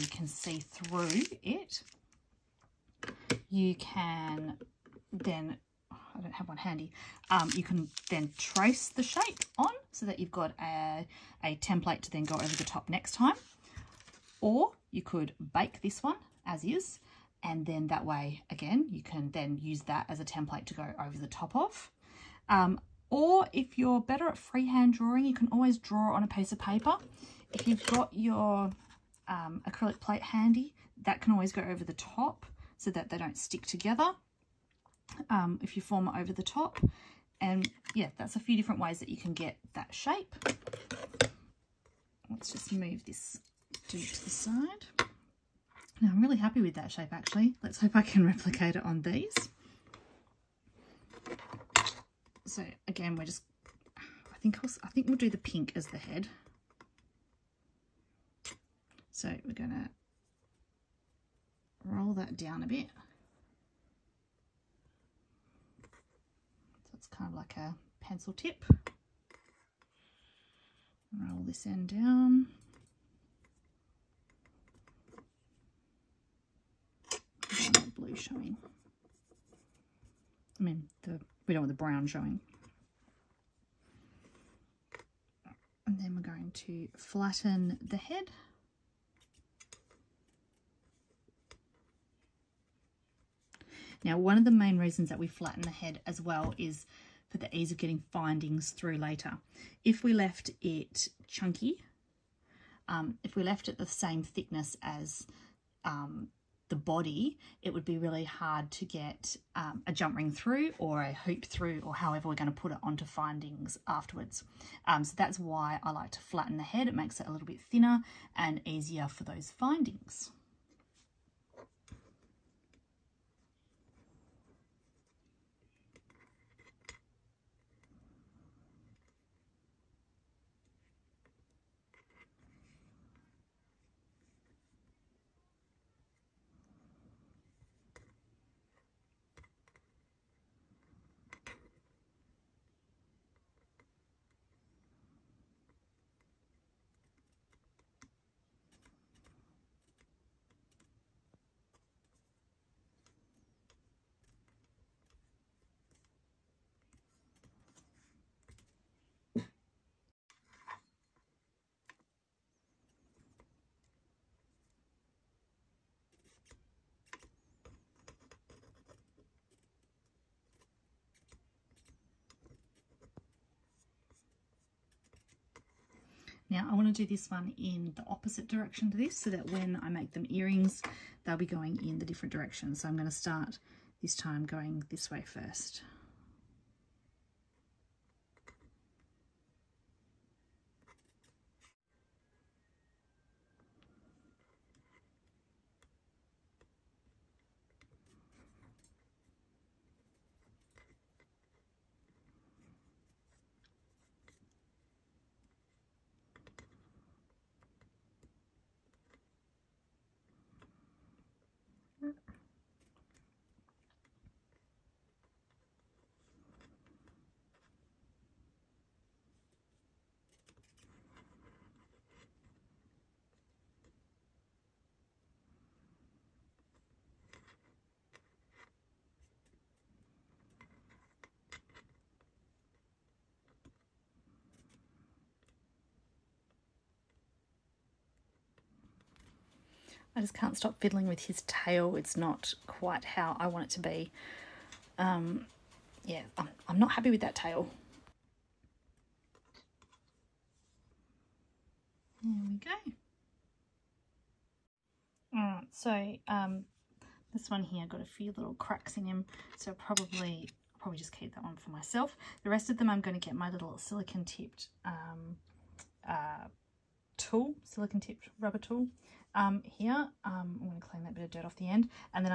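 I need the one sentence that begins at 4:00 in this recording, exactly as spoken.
I just can't stop fiddling with his tail.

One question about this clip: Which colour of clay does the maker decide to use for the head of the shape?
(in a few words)
pink.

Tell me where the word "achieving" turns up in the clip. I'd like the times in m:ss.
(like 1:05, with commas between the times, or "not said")
not said.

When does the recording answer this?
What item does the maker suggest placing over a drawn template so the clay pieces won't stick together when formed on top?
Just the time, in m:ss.
0:29.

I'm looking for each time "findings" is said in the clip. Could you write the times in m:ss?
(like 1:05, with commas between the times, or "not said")
1:38, 1:53, 1:59.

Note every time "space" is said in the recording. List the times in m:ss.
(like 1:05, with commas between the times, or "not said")
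not said.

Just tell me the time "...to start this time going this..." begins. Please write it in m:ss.
3:03.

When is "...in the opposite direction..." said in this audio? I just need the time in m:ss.
2:57.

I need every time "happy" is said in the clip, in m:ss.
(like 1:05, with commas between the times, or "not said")
0:46, 4:06.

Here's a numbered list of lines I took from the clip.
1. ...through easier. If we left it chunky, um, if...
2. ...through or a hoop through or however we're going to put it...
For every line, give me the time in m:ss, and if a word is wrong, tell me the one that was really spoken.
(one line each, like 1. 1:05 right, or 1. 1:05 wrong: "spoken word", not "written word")
1. 1:38 wrong: "later", not "easier"
2. 1:50 right.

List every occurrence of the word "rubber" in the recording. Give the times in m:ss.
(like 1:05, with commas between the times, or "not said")
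4:28.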